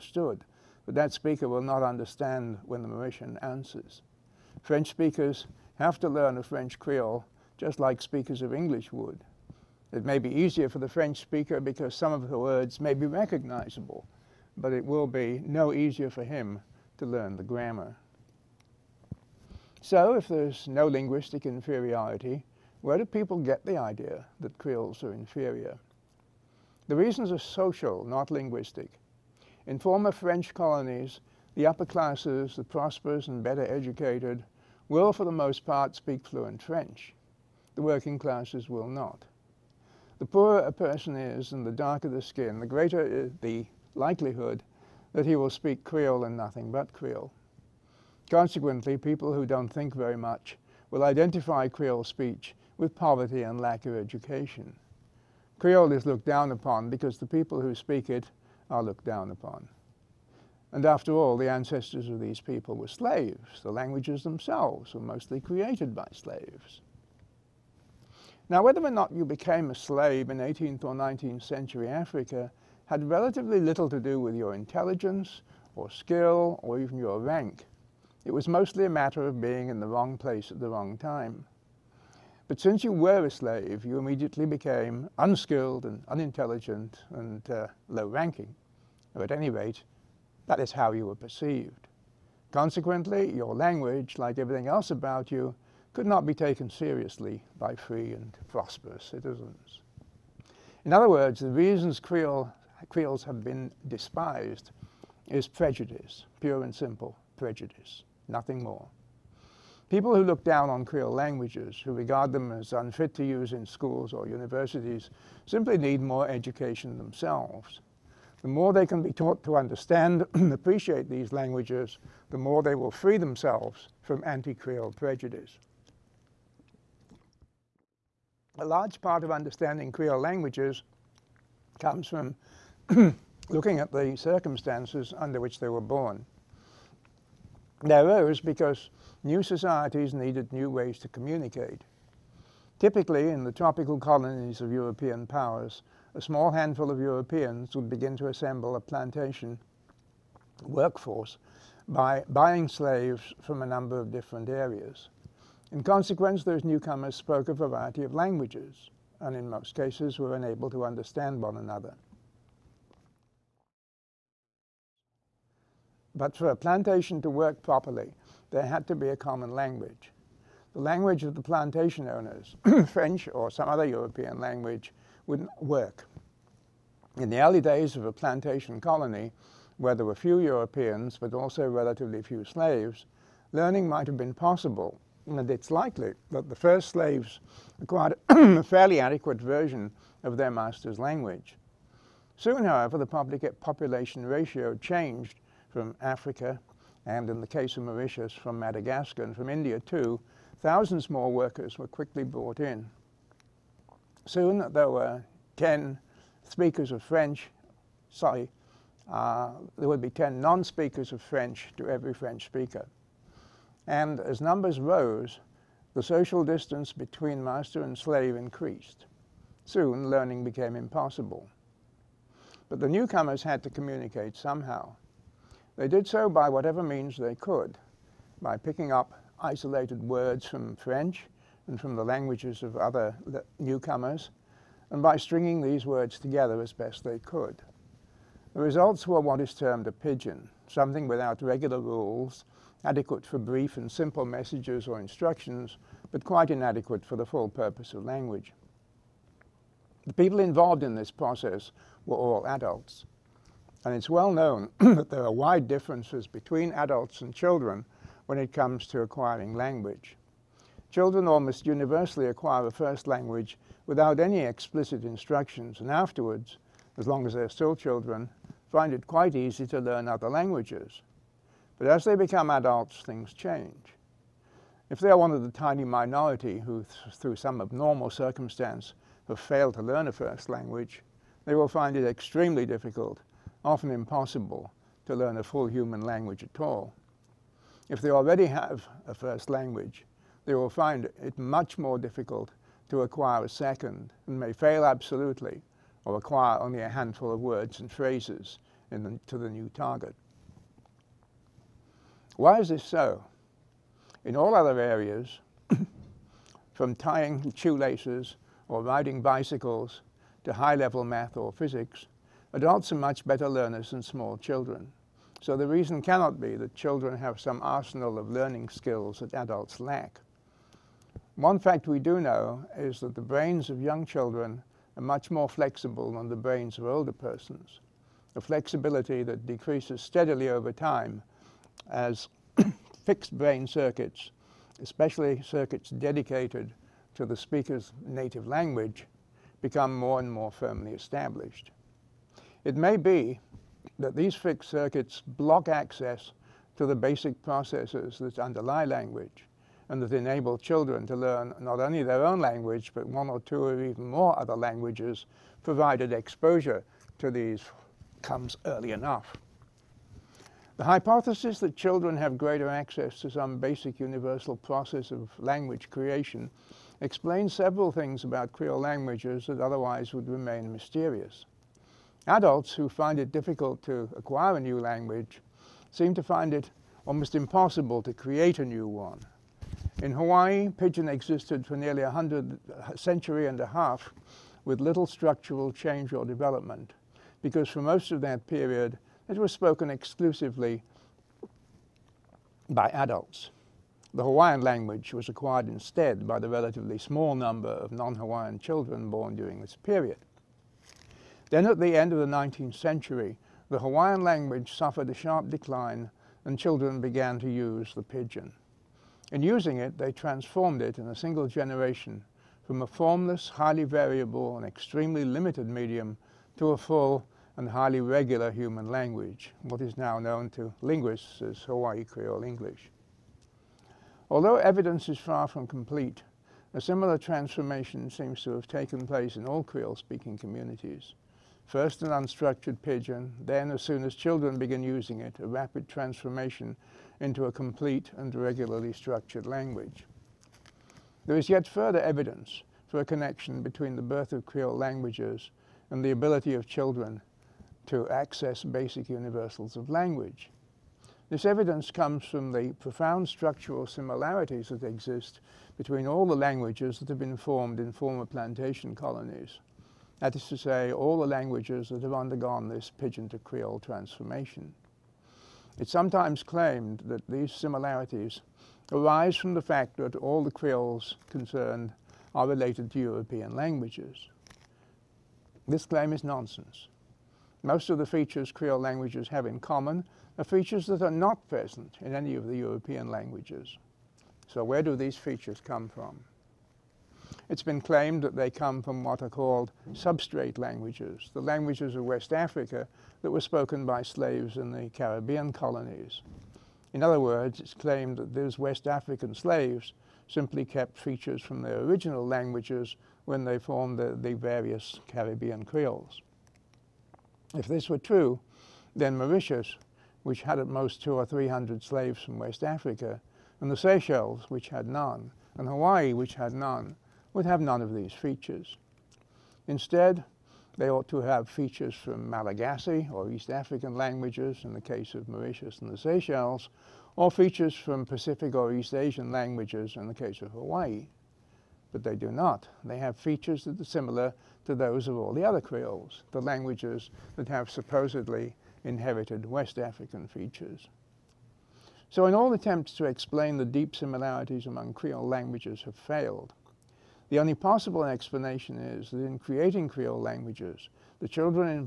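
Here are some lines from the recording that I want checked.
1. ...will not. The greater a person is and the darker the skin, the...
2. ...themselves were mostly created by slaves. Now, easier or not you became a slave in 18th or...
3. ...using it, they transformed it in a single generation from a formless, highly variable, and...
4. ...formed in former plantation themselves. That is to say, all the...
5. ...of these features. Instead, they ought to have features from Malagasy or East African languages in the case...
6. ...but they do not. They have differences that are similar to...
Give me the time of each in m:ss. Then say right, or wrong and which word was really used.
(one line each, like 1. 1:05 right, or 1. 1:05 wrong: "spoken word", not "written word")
1. 0:38 wrong: "poorer", not "greater"
2. 1:04 wrong: "whether", not "easier"
3. 6:49 right
4. 7:37 wrong: "colonies", not "themselves"
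5. 8:37 right
6. 8:51 wrong: "features", not "differences".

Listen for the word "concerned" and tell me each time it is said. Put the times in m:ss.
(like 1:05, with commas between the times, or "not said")
7:51.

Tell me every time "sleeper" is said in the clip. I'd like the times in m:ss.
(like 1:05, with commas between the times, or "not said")
not said.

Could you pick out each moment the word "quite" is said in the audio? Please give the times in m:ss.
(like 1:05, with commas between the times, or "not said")
4:06, 4:29.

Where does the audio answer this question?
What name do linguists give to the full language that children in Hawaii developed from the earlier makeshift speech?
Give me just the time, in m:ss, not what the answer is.
7:01.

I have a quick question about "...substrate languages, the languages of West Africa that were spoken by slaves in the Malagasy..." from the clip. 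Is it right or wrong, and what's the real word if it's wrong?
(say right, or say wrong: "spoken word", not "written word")
wrong: "Caribbean", not "Malagasy".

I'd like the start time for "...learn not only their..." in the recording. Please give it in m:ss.
5:51.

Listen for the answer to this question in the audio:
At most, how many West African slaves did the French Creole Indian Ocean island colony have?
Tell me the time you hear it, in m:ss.
8:31.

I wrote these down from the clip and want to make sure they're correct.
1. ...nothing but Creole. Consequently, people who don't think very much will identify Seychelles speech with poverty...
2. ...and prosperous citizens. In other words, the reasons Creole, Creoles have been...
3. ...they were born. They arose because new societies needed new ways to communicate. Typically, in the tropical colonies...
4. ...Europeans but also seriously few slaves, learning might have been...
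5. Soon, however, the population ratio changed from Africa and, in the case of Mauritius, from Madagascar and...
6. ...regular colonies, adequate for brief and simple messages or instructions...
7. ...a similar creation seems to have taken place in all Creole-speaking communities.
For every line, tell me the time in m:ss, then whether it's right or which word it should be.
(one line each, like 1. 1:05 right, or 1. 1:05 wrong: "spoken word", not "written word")
1. 0:46 wrong: "Creole", not "Seychelles"
2. 1:38 right
3. 2:15 right
4. 3:00 wrong: "relatively", not "seriously"
5. 3:12 right
6. 4:01 wrong: "rules", not "colonies"
7. 7:06 wrong: "transformation", not "creation".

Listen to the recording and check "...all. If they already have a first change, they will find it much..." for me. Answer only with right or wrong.
wrong.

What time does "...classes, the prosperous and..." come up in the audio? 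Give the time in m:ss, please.
0:31.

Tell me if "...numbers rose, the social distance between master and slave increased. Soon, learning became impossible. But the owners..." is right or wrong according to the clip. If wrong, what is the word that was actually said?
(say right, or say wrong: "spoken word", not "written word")
wrong: "newcomers", not "owners".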